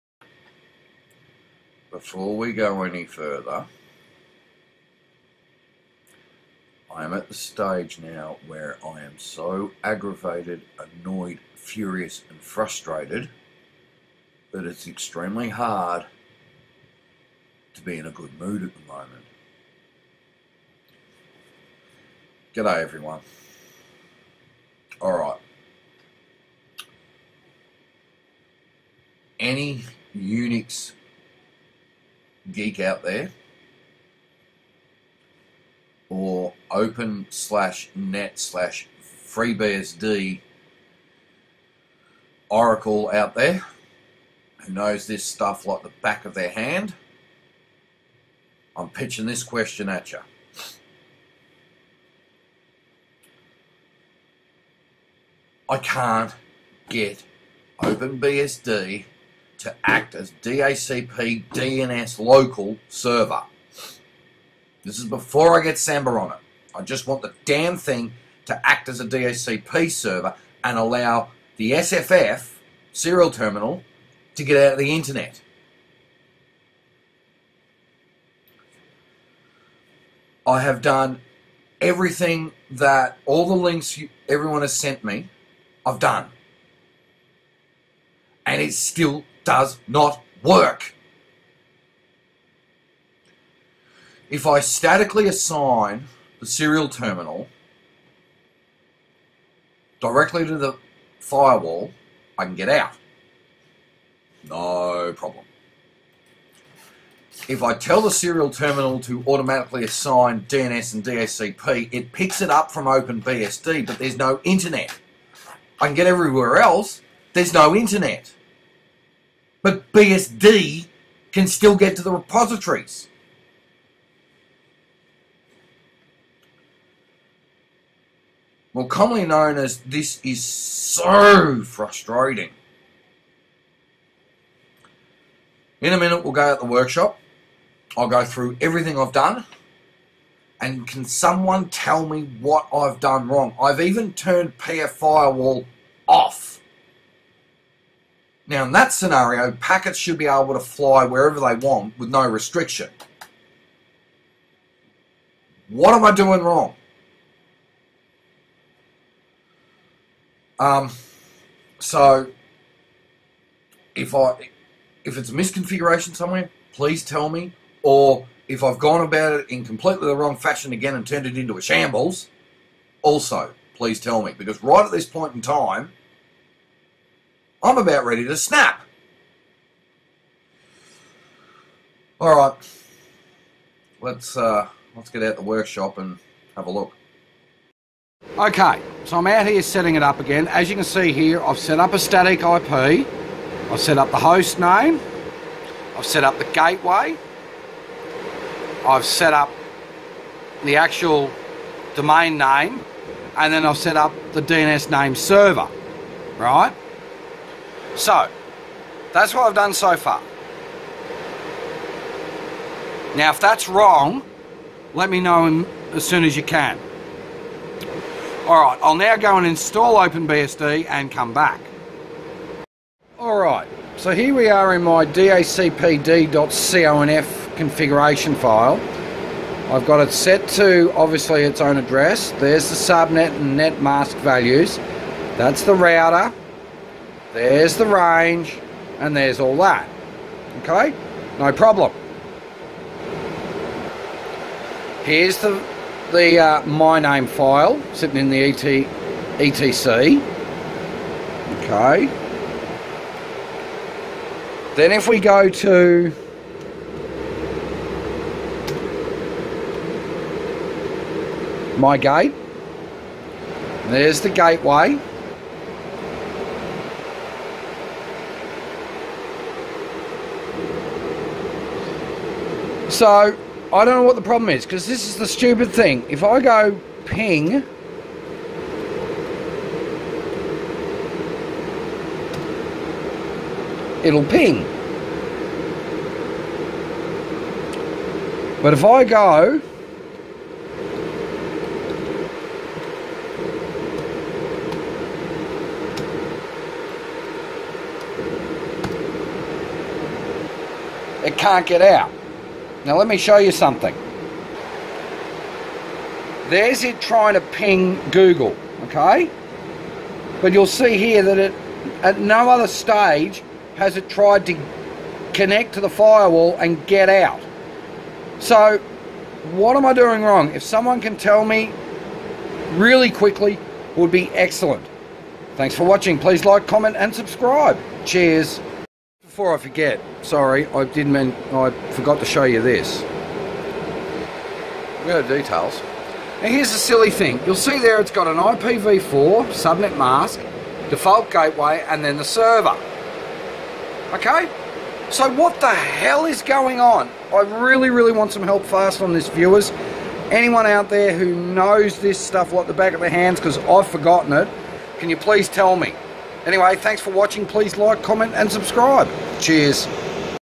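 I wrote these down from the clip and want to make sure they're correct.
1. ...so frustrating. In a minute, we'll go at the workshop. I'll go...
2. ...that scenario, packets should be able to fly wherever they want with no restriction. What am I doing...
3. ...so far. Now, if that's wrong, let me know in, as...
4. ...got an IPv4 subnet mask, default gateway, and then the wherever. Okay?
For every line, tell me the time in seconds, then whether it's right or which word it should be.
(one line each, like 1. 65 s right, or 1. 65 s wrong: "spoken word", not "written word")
1. 130 s right
2. 148 s right
3. 209 s right
4. 338 s wrong: "server", not "wherever".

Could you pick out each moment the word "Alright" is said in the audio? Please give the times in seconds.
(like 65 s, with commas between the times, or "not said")
25 s, 218 s, 223 s.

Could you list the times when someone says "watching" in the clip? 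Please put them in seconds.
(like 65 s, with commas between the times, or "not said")
325 s, 357 s.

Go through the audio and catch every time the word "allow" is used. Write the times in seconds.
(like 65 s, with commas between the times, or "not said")
70 s.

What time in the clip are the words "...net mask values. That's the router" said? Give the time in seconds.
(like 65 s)
233 s.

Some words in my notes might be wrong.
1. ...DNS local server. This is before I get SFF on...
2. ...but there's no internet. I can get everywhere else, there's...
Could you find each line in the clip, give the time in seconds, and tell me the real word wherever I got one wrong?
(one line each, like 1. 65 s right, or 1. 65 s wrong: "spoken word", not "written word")
1. 61 s wrong: "Samba", not "SFF"
2. 113 s right.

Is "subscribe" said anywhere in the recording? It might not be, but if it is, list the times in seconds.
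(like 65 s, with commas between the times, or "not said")
327 s, 358 s.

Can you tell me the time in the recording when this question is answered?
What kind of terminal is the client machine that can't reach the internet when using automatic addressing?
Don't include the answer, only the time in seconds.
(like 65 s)
71 s.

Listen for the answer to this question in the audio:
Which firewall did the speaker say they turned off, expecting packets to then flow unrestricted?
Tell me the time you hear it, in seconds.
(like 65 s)
144 s.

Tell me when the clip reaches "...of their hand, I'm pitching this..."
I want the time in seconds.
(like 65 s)
46 s.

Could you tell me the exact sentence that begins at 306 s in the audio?
There's it trying to ping Google, okay?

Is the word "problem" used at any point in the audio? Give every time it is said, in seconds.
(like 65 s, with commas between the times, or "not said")
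105 s, 241 s, 274 s.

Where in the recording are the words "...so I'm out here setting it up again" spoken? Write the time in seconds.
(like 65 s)
189 s.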